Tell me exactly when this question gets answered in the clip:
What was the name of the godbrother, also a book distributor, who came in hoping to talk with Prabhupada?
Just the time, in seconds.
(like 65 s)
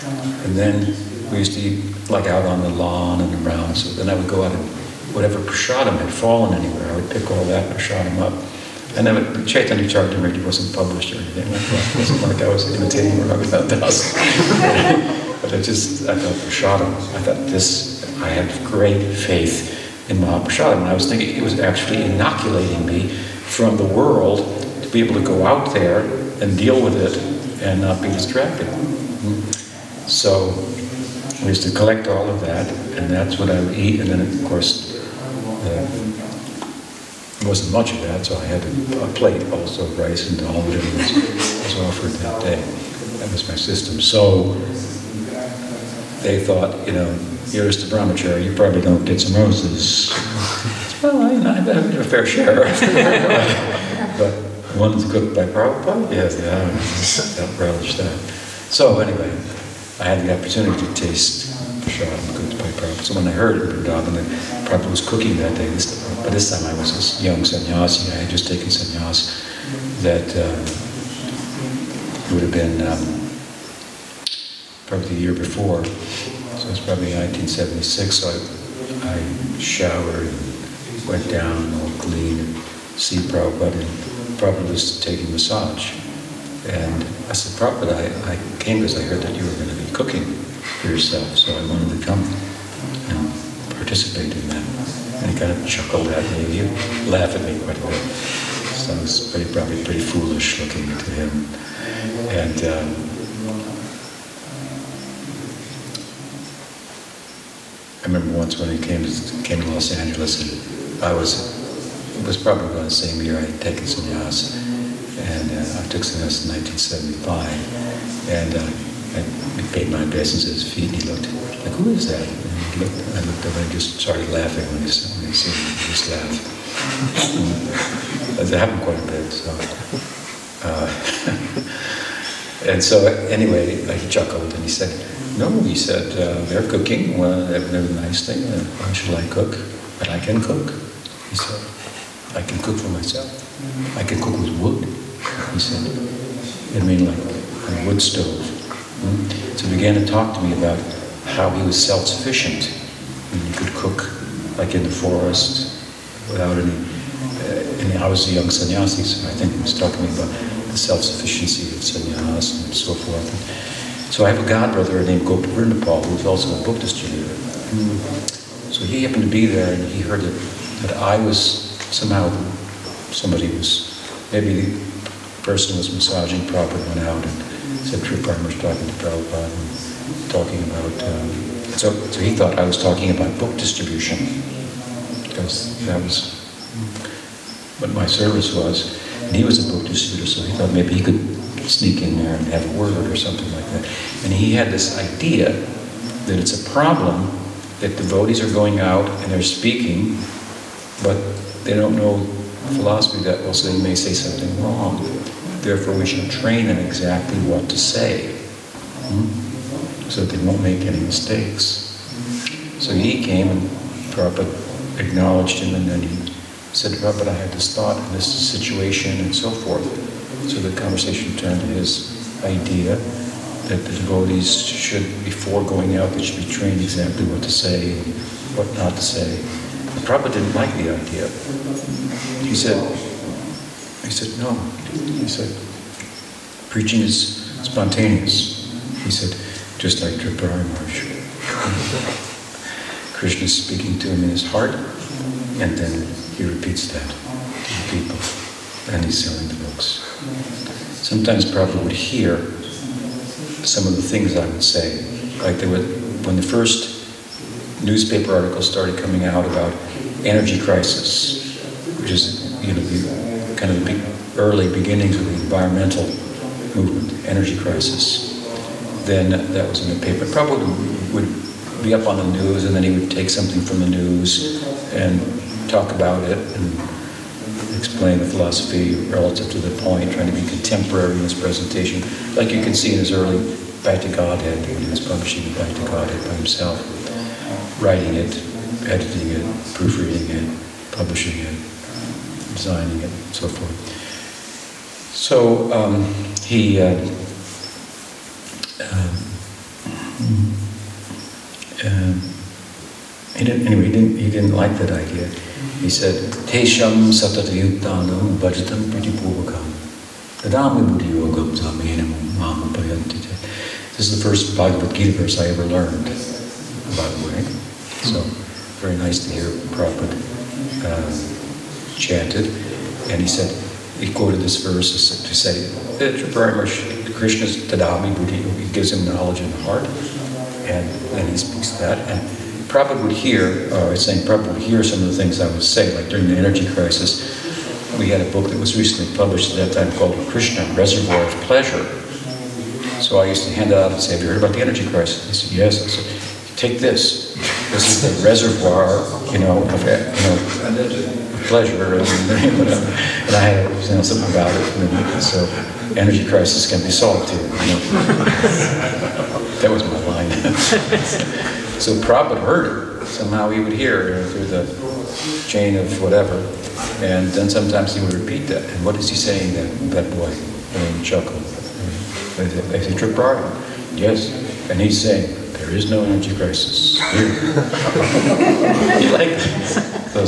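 165 s.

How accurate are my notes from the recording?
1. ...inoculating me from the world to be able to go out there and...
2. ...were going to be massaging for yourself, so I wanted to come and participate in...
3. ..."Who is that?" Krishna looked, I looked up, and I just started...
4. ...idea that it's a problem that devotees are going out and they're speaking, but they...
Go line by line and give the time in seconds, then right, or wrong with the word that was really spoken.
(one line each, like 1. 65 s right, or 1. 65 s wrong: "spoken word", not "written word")
1. 22 s right
2. 89 s wrong: "cooking", not "massaging"
3. 121 s wrong: "And", not "Krishna"
4. 194 s right.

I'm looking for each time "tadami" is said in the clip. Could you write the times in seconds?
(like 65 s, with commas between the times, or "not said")
310 s, 327 s.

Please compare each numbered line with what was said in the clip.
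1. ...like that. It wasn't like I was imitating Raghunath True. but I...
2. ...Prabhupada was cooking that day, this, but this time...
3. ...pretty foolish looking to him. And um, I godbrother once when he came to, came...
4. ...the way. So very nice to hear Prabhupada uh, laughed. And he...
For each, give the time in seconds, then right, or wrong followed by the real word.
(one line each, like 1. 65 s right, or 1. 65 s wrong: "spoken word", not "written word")
1. 11 s wrong: "Das", not "True"
2. 64 s right
3. 99 s wrong: "remember", not "godbrother"
4. 317 s wrong: "chanted", not "laughed".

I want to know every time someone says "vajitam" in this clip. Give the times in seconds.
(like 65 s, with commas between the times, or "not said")
308 s.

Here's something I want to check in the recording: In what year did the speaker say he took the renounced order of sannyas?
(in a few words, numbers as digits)
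1975.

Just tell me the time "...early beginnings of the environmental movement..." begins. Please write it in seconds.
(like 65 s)
264 s.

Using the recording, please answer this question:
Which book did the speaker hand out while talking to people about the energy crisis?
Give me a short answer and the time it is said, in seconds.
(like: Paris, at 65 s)
Krishna, Reservoir of Pleasure, at 340 s.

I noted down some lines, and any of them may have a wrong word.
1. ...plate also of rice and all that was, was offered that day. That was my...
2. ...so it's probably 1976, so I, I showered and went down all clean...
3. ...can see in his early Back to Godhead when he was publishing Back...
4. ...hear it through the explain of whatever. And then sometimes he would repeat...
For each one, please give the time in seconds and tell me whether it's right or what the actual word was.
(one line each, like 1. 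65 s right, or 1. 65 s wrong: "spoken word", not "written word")
1. 39 s right
2. 75 s right
3. 282 s right
4. 363 s wrong: "chain", not "explain".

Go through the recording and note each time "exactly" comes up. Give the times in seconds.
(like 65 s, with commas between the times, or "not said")
206 s, 226 s.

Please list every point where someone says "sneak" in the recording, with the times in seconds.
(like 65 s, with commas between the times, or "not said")
191 s.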